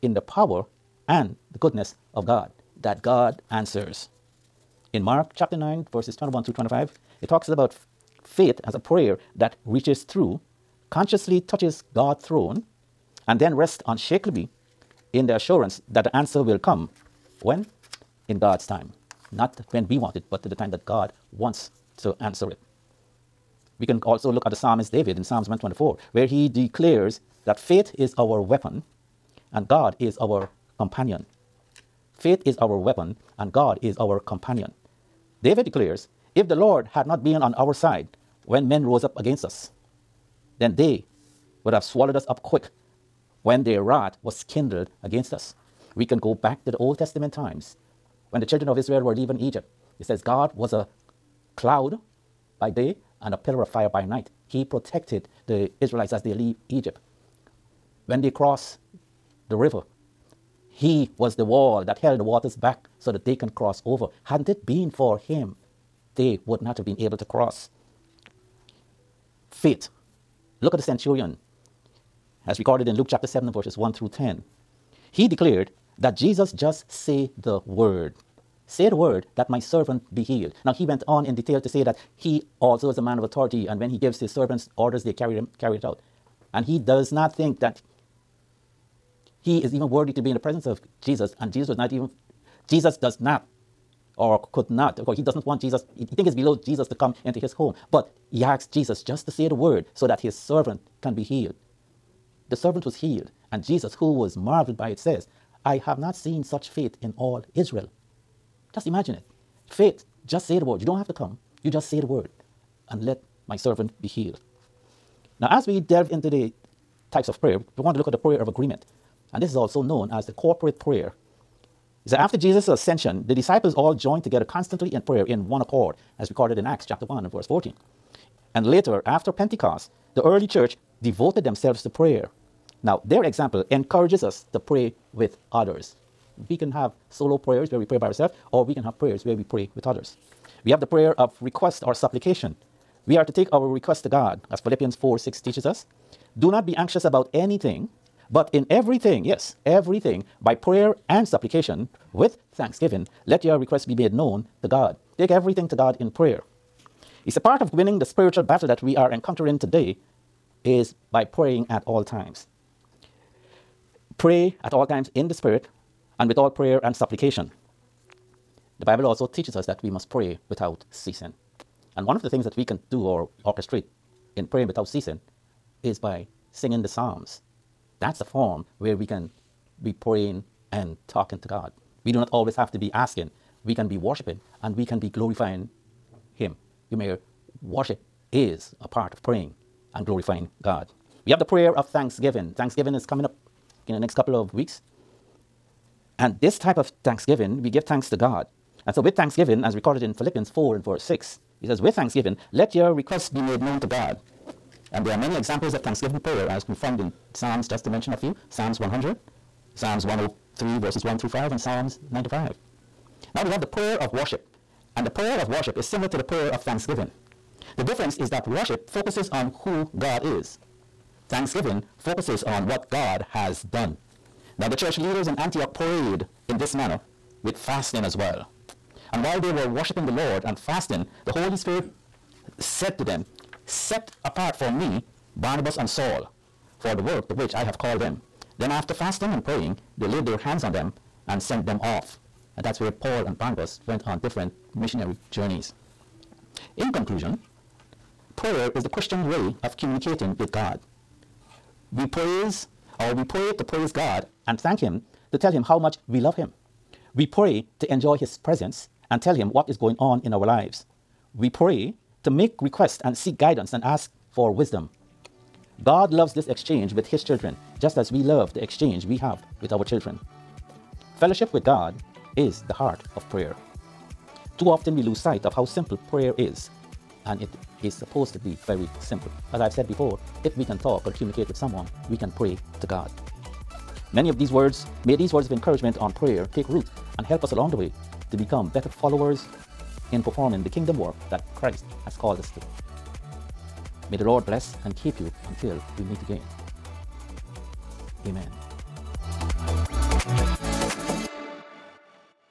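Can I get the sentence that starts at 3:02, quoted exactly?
We do not always have to be asking, we can be worshiping and we can be glorifying Him.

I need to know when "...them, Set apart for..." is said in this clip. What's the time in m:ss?
3:53.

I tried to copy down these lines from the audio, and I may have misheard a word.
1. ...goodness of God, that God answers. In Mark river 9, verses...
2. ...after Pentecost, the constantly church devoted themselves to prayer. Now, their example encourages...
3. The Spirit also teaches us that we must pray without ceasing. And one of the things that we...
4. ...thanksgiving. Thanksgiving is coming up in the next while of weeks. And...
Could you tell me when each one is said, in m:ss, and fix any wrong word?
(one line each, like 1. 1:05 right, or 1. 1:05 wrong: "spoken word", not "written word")
1. 0:01 wrong: "chapter", not "river"
2. 2:09 wrong: "early", not "constantly"
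3. 2:48 wrong: "Bible", not "Spirit"
4. 3:11 wrong: "couple", not "while".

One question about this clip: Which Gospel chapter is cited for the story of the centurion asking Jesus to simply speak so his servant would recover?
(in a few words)
Luke 7.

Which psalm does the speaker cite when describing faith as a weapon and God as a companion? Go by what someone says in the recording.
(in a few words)
Psalm 124.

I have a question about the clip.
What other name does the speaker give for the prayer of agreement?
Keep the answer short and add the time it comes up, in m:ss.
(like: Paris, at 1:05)
corporate prayer, at 2:00.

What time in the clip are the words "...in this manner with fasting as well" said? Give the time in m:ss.
3:46.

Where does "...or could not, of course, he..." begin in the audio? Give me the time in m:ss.
1:34.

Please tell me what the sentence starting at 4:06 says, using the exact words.
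In conclusion, prayer is the Christian's way of communicating with God.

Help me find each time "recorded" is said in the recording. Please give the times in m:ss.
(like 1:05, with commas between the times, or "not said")
1:12, 2:06, 3:19.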